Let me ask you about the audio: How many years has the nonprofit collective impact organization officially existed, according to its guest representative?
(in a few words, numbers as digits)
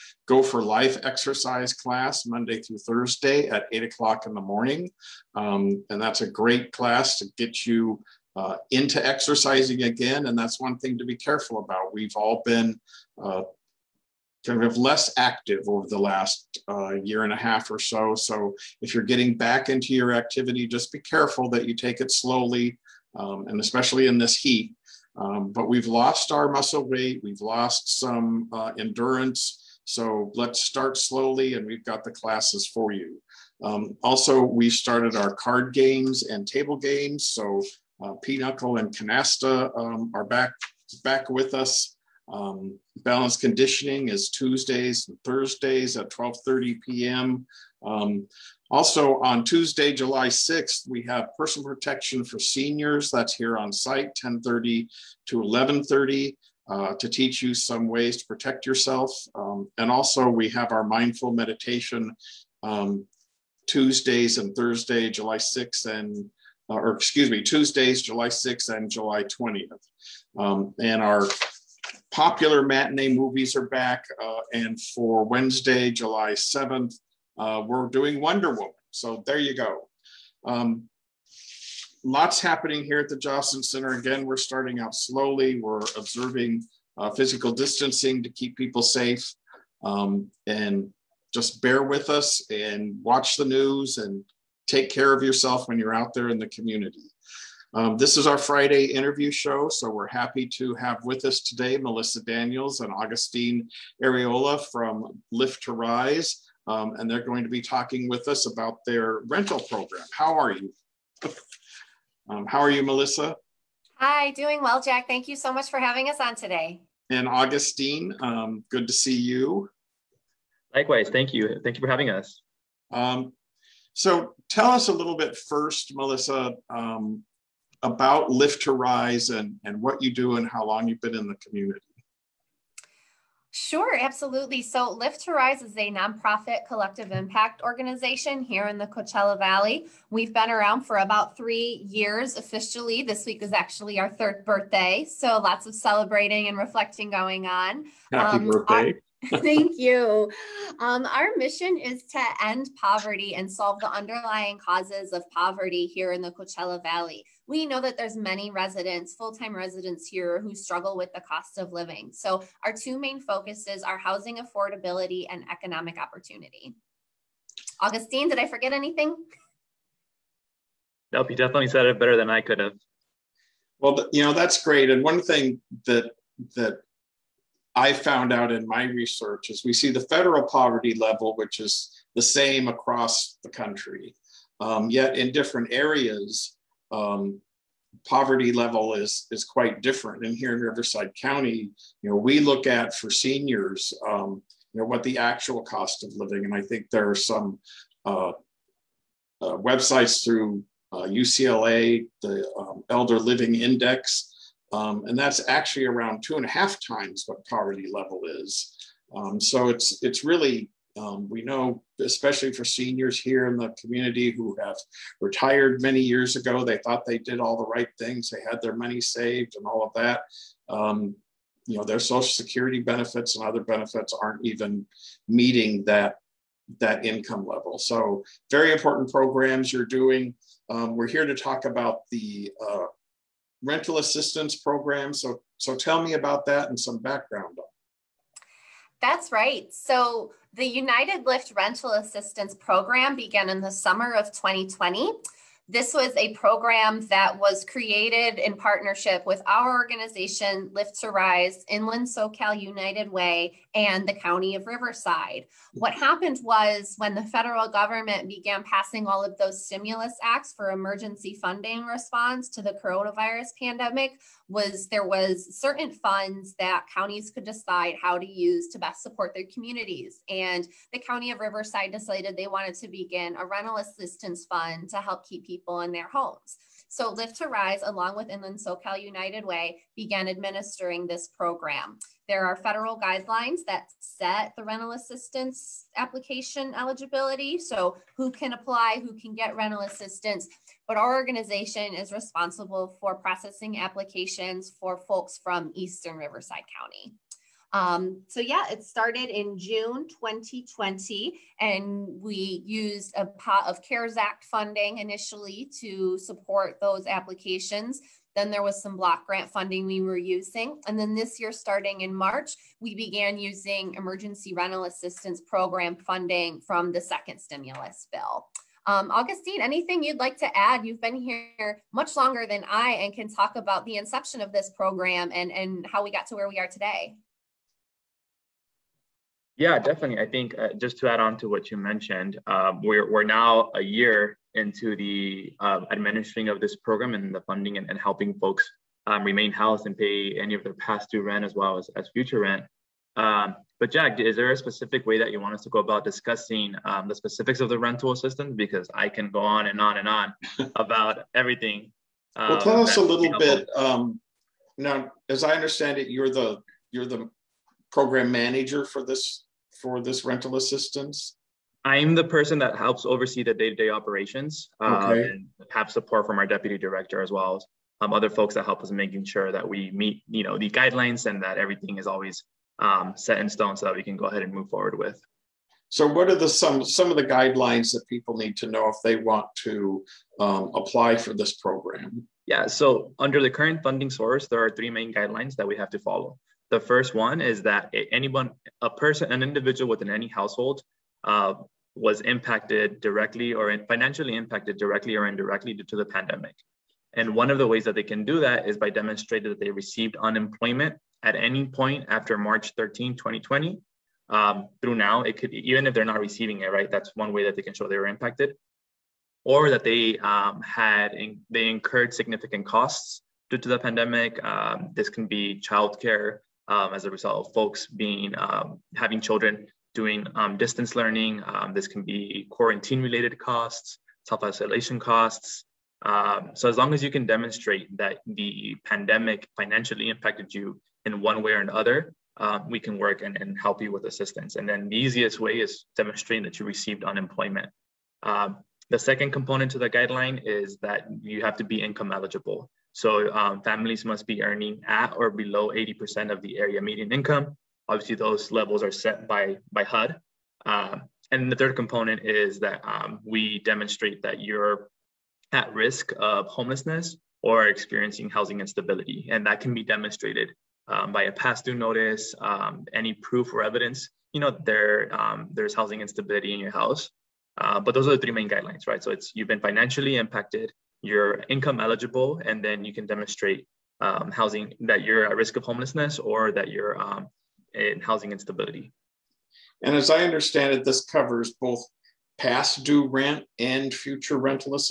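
3.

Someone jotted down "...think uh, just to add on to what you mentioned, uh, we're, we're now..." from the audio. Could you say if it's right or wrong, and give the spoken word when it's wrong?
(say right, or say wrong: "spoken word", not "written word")
right.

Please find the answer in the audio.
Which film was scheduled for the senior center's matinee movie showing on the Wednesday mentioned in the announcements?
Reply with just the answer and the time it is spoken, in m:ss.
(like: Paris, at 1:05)
Wonder Woman, at 1:18.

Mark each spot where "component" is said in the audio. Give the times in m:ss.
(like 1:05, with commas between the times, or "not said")
7:19, 7:31.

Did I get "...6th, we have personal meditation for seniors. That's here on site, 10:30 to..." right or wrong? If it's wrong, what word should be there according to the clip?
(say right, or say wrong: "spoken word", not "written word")
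wrong: "protection", not "meditation".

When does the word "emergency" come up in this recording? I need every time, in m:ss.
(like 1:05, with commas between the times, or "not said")
4:20, 5:13.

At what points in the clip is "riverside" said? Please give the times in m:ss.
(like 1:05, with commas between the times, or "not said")
3:10, 4:14, 4:31, 4:56.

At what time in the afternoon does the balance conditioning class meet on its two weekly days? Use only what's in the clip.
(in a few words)
12:30 p.m.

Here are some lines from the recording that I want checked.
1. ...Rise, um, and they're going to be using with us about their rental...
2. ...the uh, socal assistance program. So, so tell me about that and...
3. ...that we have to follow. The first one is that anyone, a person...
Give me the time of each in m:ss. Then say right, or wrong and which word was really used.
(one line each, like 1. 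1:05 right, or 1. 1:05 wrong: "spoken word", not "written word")
1. 1:45 wrong: "talking", not "using"
2. 3:52 wrong: "rental", not "socal"
3. 6:25 right.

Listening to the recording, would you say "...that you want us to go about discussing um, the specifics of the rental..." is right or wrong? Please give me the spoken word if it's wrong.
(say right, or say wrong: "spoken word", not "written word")
right.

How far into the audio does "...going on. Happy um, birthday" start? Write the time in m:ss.
2:27.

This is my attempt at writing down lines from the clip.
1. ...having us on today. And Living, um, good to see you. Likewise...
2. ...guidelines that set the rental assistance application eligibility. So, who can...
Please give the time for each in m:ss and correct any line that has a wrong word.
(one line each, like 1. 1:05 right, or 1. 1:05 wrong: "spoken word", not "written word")
1. 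1:55 wrong: "Augustine", not "Living"
2. 4:42 right.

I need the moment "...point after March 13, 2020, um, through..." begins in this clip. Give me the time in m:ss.
6:41.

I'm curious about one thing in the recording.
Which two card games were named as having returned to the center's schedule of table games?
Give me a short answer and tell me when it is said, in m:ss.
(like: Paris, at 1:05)
Pinochle and Canasta, at 0:38.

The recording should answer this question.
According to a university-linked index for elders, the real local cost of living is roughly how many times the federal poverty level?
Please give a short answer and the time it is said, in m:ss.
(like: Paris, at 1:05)
2.5 times, at 3:26.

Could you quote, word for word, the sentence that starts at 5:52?
Um, well, tell us a little bit.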